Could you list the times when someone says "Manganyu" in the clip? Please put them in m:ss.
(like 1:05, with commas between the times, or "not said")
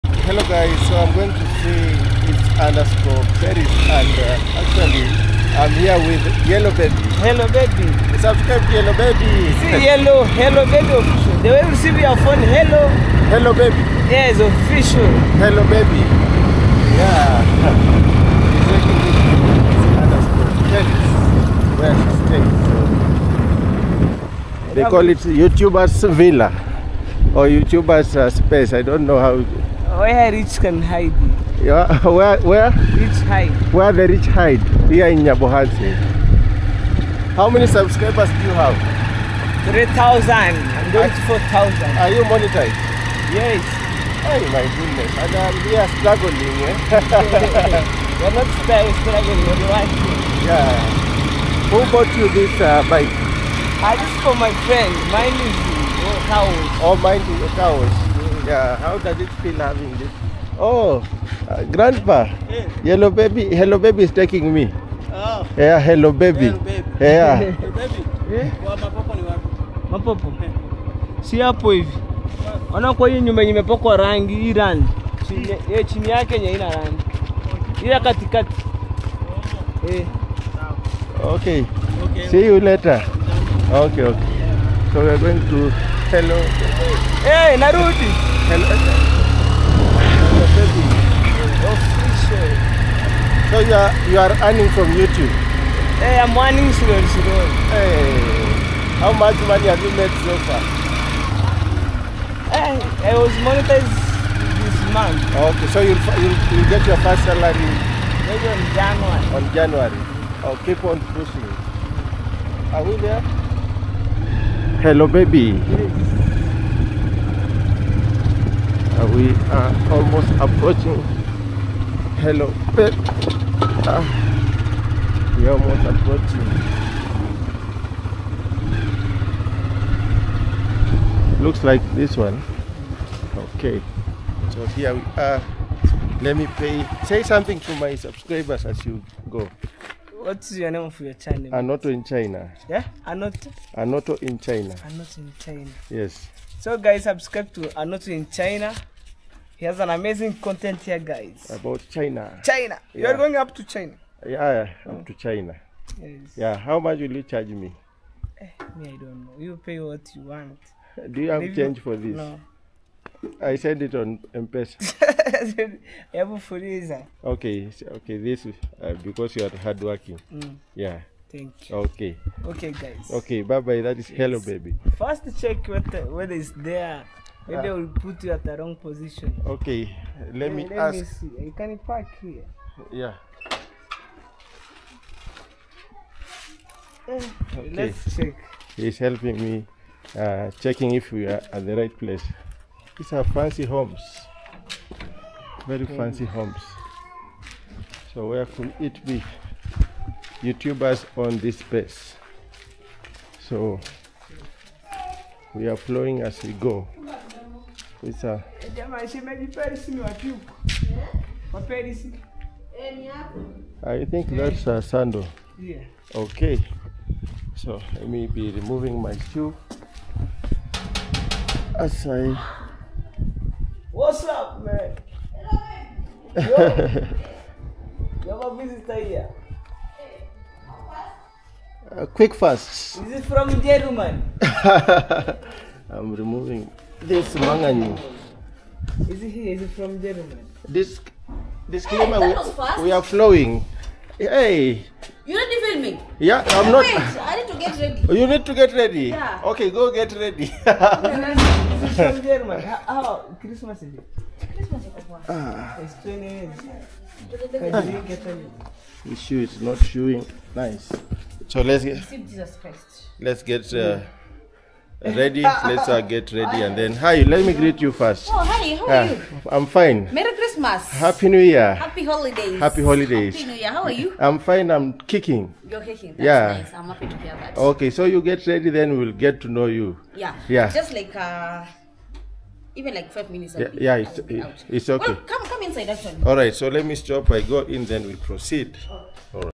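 3:57.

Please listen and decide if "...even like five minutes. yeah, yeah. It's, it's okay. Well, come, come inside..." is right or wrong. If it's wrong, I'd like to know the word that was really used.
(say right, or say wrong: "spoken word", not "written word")
right.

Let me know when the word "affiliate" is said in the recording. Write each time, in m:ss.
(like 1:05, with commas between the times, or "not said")
not said.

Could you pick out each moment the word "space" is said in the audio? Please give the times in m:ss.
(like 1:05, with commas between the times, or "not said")
0:28, 3:21.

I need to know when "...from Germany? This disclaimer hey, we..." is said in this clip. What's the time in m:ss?
3:59.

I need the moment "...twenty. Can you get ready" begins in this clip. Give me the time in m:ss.
4:16.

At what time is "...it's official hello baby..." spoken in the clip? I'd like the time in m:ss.
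0:14.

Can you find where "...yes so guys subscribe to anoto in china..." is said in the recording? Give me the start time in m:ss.
2:25.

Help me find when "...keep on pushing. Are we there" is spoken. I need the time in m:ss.
1:50.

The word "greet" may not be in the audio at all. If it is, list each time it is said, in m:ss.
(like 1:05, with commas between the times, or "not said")
4:27.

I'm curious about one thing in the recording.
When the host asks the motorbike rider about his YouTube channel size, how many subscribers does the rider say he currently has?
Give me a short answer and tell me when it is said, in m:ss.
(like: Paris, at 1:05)
3,000, at 0:39.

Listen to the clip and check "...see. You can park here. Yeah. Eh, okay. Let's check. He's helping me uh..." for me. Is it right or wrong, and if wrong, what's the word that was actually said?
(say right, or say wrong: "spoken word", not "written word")
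right.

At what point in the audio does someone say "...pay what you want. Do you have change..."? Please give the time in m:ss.
2:39.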